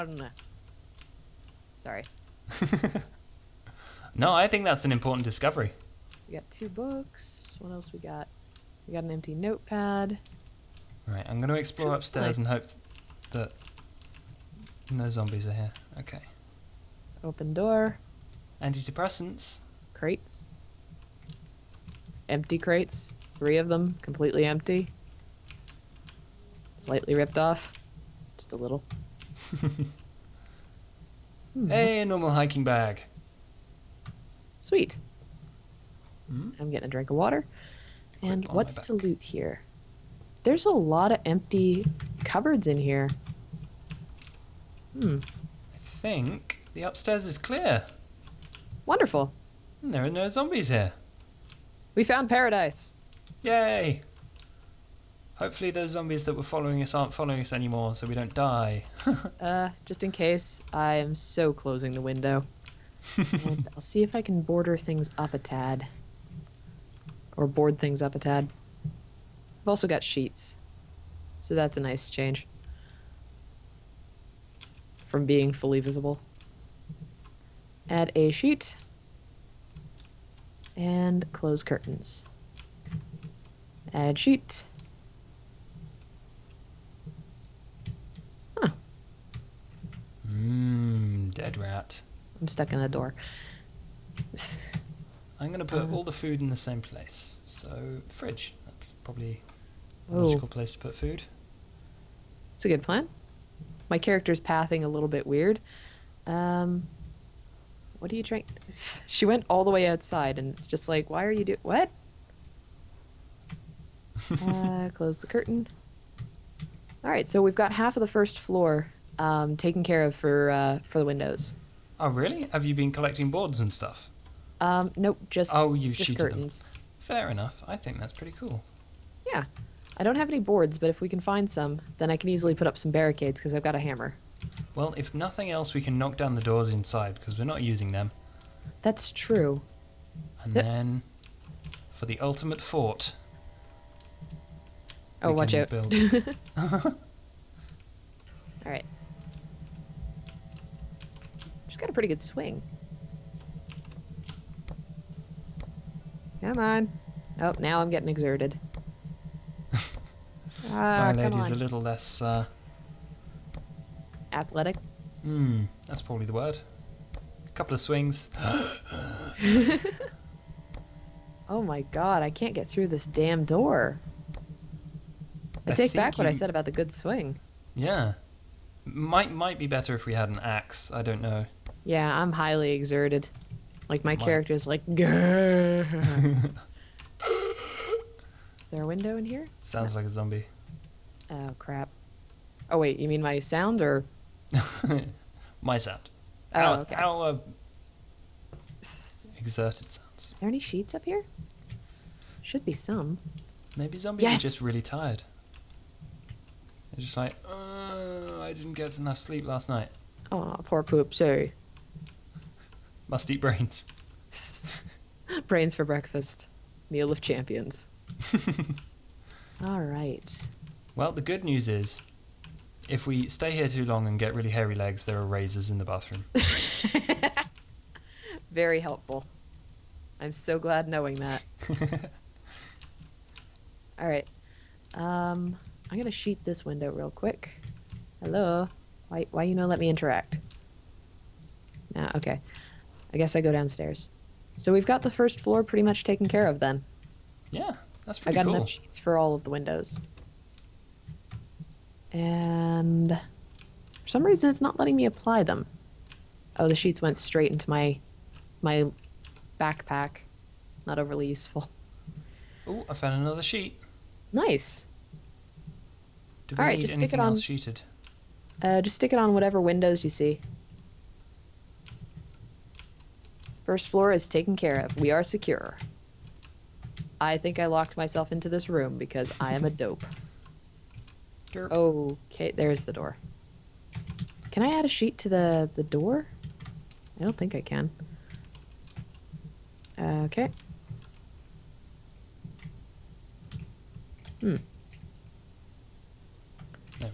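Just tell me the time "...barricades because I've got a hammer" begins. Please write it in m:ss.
2:12.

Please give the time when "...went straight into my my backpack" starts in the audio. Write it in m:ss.
4:17.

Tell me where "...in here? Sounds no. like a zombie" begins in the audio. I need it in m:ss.
3:09.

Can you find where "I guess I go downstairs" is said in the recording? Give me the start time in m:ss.
4:03.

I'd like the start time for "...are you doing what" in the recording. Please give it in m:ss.
1:51.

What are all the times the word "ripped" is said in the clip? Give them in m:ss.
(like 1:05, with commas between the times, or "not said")
0:27.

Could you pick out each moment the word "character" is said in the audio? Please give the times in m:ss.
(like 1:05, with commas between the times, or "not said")
1:43, 3:04.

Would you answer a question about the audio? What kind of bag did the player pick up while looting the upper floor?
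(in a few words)
normal hiking bag.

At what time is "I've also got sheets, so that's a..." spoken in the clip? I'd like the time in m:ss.
1:08.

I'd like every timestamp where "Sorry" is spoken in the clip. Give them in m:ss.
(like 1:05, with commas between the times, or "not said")
0:01, 3:31.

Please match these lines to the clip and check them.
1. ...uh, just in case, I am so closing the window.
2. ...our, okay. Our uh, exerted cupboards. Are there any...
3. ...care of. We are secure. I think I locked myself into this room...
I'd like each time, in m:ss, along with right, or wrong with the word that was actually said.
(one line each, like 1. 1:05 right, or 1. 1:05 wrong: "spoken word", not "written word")
1. 0:59 right
2. 3:16 wrong: "sounds", not "cupboards"
3. 4:34 right.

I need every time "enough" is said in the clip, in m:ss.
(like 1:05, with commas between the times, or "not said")
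2:07, 3:28, 4:08.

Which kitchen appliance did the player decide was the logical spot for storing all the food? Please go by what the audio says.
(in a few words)
fridge.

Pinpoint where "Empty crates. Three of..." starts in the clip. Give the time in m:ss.
0:22.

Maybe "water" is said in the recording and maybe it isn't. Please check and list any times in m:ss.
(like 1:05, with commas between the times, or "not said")
0:37.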